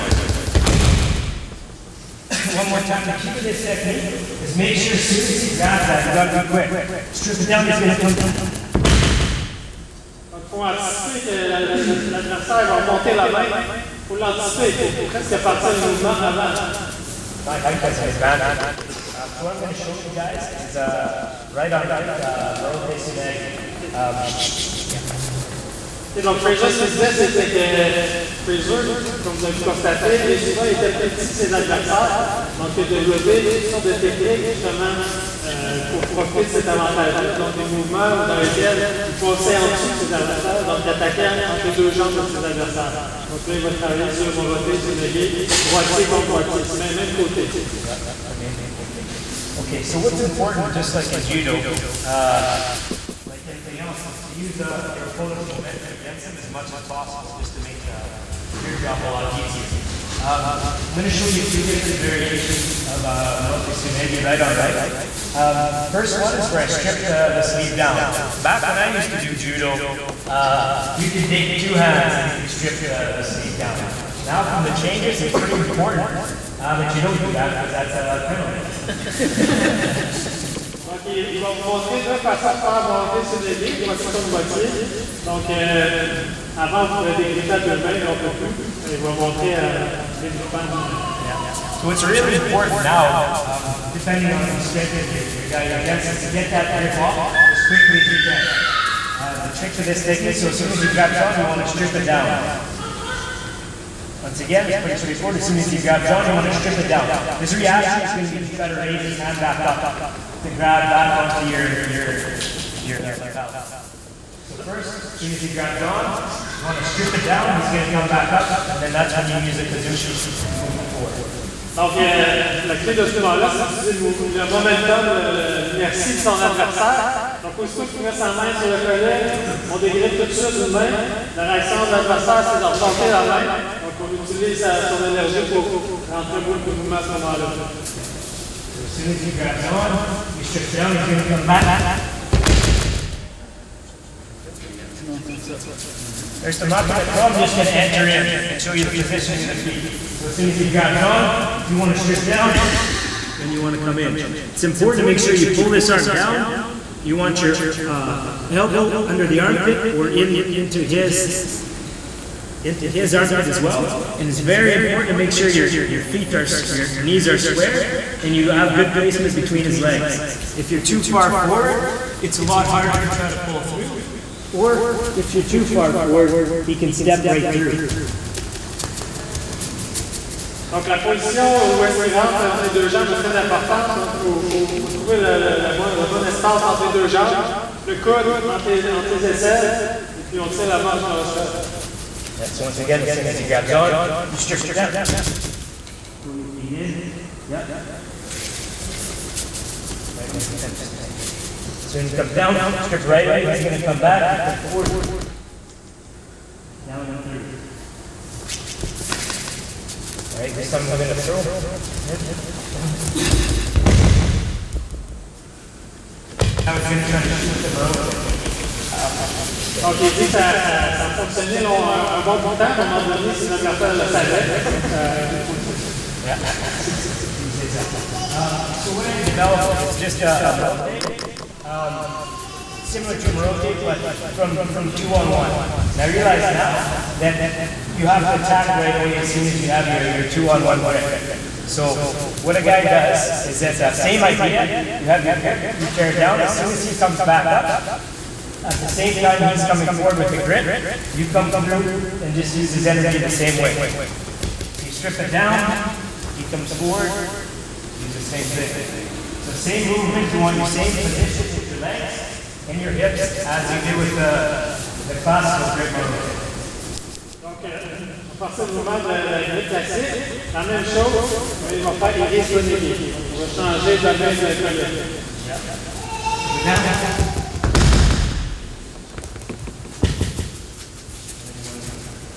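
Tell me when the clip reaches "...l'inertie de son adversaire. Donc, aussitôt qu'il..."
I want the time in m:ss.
2:05.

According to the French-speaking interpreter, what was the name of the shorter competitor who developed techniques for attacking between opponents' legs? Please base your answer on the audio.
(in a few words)
Fraser.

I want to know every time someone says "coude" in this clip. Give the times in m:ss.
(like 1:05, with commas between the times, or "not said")
3:07.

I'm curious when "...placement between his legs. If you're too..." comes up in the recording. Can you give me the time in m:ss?
2:48.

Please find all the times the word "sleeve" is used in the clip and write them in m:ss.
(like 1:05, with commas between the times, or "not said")
1:07, 1:13.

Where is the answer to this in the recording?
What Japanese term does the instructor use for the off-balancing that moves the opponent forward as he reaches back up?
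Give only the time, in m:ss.
1:59.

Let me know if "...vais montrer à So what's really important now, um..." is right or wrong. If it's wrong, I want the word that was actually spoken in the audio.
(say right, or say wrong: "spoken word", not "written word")
right.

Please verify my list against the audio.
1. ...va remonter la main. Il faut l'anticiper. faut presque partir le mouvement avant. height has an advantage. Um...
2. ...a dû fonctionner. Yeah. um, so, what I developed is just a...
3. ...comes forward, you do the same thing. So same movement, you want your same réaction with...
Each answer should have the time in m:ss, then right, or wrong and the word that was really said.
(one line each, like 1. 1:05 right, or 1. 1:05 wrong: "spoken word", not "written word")
1. 0:12 right
2. 3:45 right
3. 4:16 wrong: "position", not "réaction".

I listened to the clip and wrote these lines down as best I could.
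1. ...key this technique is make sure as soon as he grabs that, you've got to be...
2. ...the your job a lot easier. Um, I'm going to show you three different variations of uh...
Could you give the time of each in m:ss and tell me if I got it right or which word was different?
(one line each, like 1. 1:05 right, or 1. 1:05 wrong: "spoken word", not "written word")
1. 0:03 right
2. 0:57 wrong: "two", not "three".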